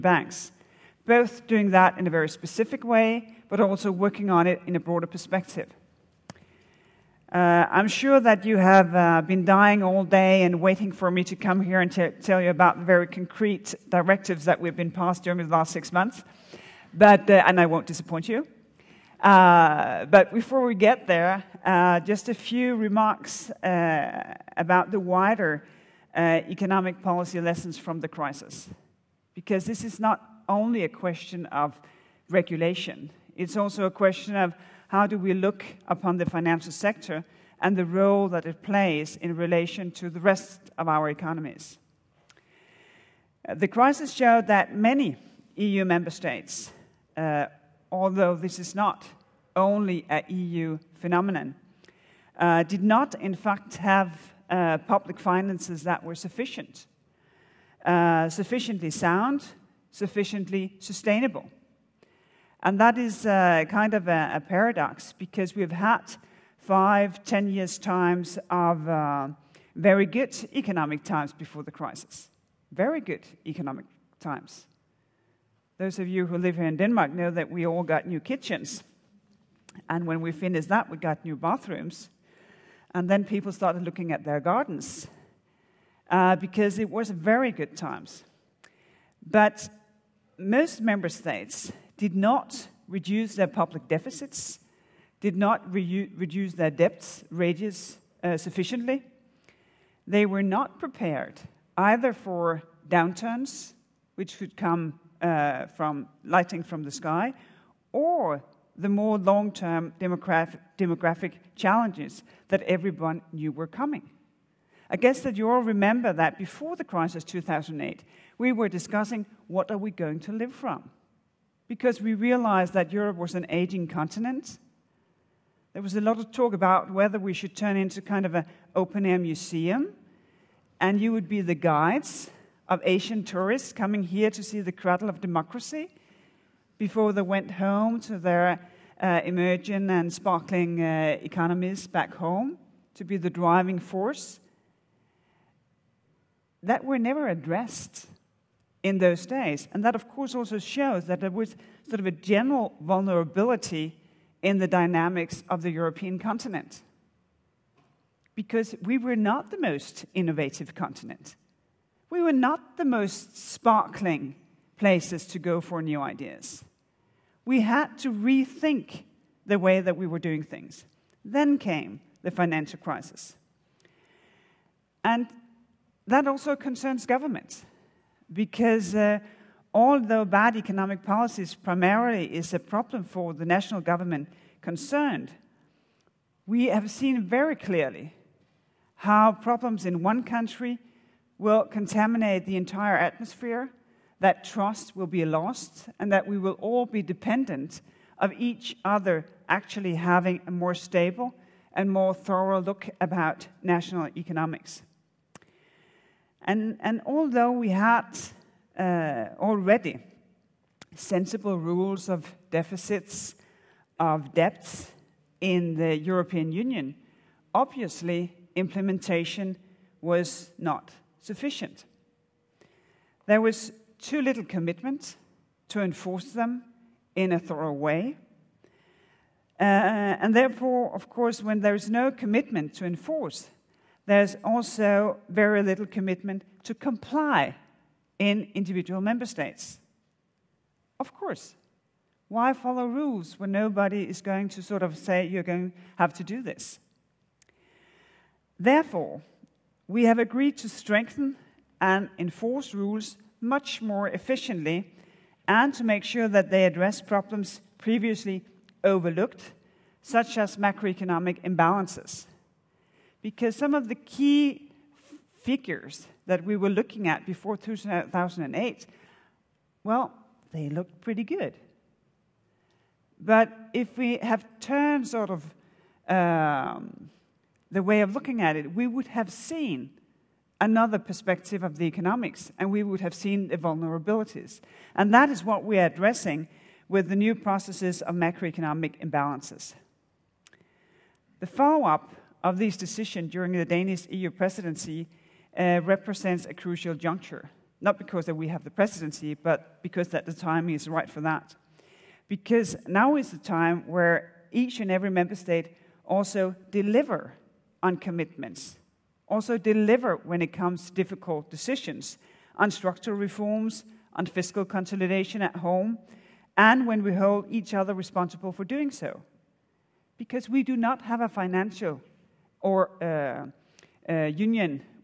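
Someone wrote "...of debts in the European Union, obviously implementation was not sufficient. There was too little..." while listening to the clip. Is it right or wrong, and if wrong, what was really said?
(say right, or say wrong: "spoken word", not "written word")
right.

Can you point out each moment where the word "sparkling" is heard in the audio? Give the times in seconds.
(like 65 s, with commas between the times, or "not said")
140 s, 163 s.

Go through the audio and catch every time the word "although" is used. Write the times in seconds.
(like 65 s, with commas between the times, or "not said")
47 s, 179 s, 207 s.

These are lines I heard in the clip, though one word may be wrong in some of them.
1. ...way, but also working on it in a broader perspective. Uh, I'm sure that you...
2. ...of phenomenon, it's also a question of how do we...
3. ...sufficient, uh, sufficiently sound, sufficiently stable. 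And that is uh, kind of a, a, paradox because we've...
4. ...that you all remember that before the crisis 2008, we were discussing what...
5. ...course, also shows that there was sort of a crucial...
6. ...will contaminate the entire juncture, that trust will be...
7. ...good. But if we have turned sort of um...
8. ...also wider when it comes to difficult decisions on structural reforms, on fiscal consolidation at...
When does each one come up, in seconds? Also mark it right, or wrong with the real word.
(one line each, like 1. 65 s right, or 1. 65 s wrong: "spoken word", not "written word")
1. 2 s right
2. 31 s wrong: "regulation", not "phenomenon"
3. 56 s wrong: "sustainable", not "stable"
4. 115 s right
5. 150 s wrong: "general", not "crucial"
6. 191 s wrong: "atmosphere", not "juncture"
7. 271 s right
8. 309 s wrong: "deliver", not "wider".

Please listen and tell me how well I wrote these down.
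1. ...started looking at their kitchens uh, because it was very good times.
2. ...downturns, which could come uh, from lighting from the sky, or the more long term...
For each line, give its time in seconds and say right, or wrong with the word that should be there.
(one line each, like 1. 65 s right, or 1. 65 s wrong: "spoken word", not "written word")
1. 83 s wrong: "gardens", not "kitchens"
2. 102 s right.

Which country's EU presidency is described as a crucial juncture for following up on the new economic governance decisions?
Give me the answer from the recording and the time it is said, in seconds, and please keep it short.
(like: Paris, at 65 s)
Denmark, at 293 s.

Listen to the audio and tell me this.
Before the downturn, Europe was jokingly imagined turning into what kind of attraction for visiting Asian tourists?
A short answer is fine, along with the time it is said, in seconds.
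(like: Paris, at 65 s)
open air museum, at 128 s.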